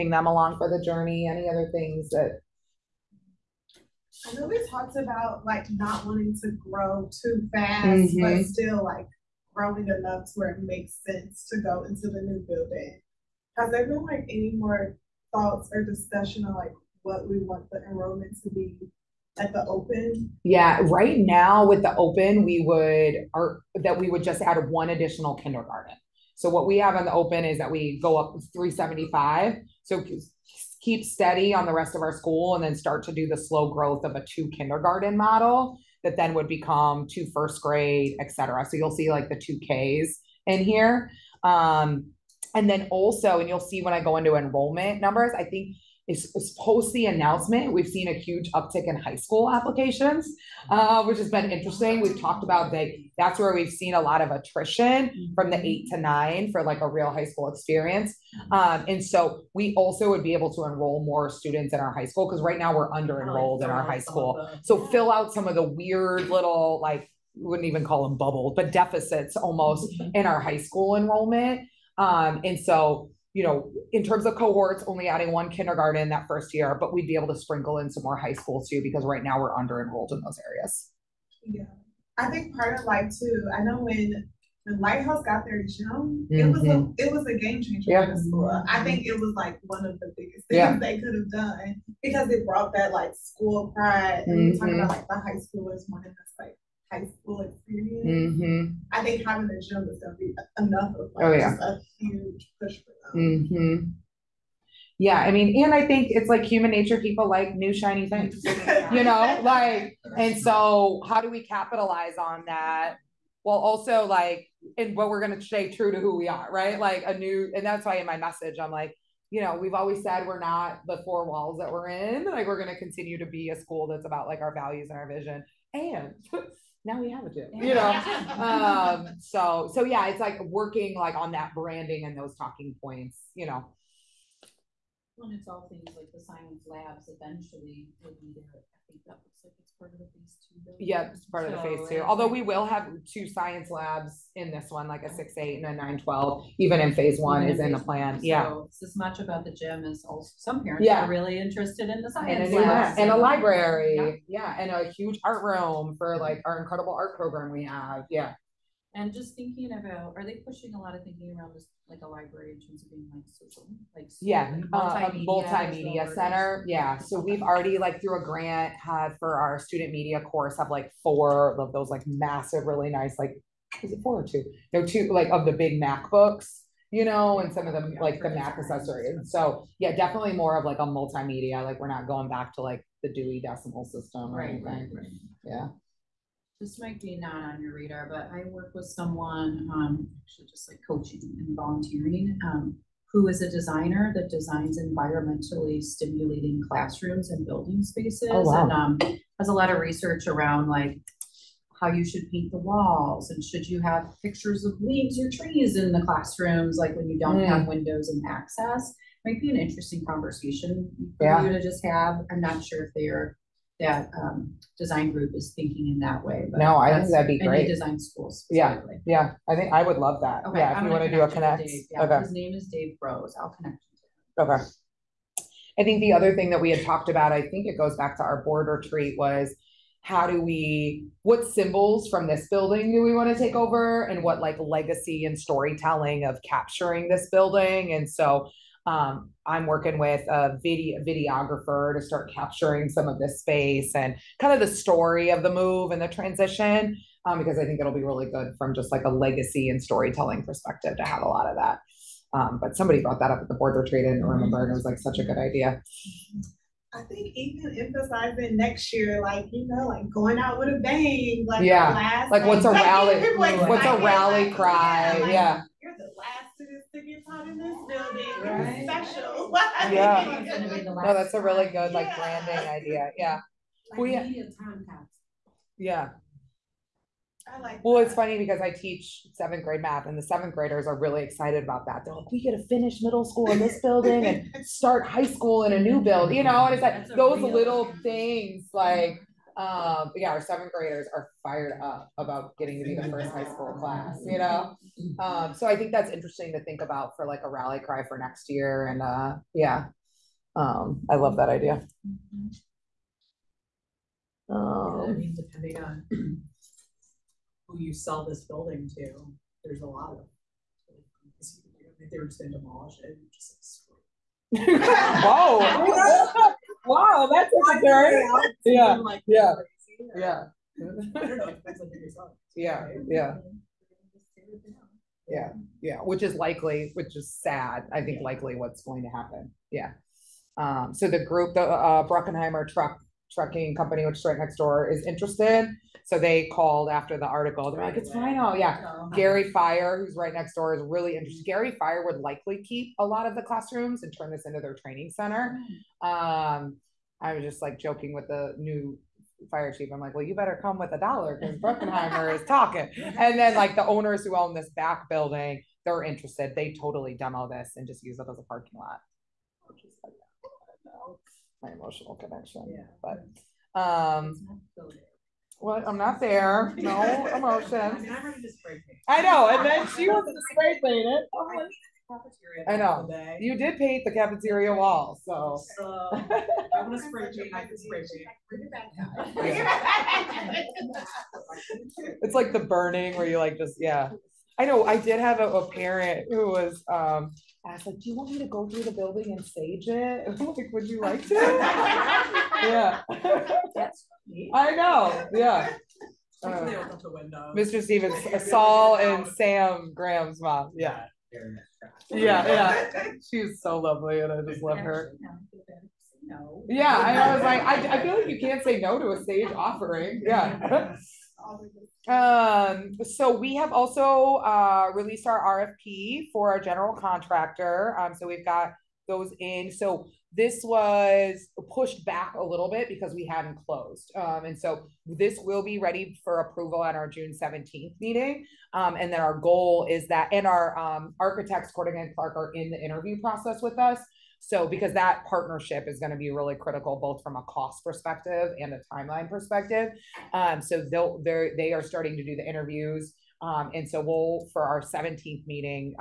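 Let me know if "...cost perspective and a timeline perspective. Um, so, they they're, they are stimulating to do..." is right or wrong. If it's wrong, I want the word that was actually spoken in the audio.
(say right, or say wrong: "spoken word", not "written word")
wrong: "starting", not "stimulating".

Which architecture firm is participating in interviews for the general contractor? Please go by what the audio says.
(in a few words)
Cordogan and Clark.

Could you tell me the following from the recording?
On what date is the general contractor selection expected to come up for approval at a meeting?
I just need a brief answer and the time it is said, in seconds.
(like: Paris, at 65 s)
June 17th, at 427 s.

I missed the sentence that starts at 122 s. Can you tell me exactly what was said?
Like, we're going to continue to be a school that's about like our values and our vision.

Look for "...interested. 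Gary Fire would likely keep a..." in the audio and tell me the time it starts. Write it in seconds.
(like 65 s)
341 s.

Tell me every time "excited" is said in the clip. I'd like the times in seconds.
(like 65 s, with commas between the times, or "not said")
281 s.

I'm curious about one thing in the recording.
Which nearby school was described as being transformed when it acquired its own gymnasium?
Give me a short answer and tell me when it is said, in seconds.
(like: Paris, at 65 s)
the Lighthouse, at 84 s.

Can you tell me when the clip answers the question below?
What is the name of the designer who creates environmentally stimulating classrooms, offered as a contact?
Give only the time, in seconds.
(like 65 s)
222 s.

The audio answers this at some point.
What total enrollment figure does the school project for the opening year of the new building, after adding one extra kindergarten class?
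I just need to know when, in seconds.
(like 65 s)
28 s.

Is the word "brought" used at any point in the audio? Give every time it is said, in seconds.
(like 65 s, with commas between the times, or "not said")
92 s, 253 s.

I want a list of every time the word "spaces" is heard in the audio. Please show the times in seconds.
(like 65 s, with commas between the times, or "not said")
197 s, 243 s.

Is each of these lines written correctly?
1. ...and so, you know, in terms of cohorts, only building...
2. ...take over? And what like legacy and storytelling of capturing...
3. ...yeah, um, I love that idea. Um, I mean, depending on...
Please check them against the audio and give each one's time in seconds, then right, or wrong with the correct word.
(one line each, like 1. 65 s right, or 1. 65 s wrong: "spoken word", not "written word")
1. 72 s wrong: "adding", not "building"
2. 233 s right
3. 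299 s right.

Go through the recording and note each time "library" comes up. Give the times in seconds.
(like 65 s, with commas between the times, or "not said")
153 s, 162 s.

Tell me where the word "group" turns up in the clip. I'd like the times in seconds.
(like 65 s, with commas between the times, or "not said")
215 s, 331 s.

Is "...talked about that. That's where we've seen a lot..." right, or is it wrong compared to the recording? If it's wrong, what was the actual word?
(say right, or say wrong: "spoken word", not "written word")
right.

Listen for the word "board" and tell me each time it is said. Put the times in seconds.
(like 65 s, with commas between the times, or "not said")
228 s, 253 s.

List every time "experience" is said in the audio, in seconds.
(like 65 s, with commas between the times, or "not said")
57 s, 97 s.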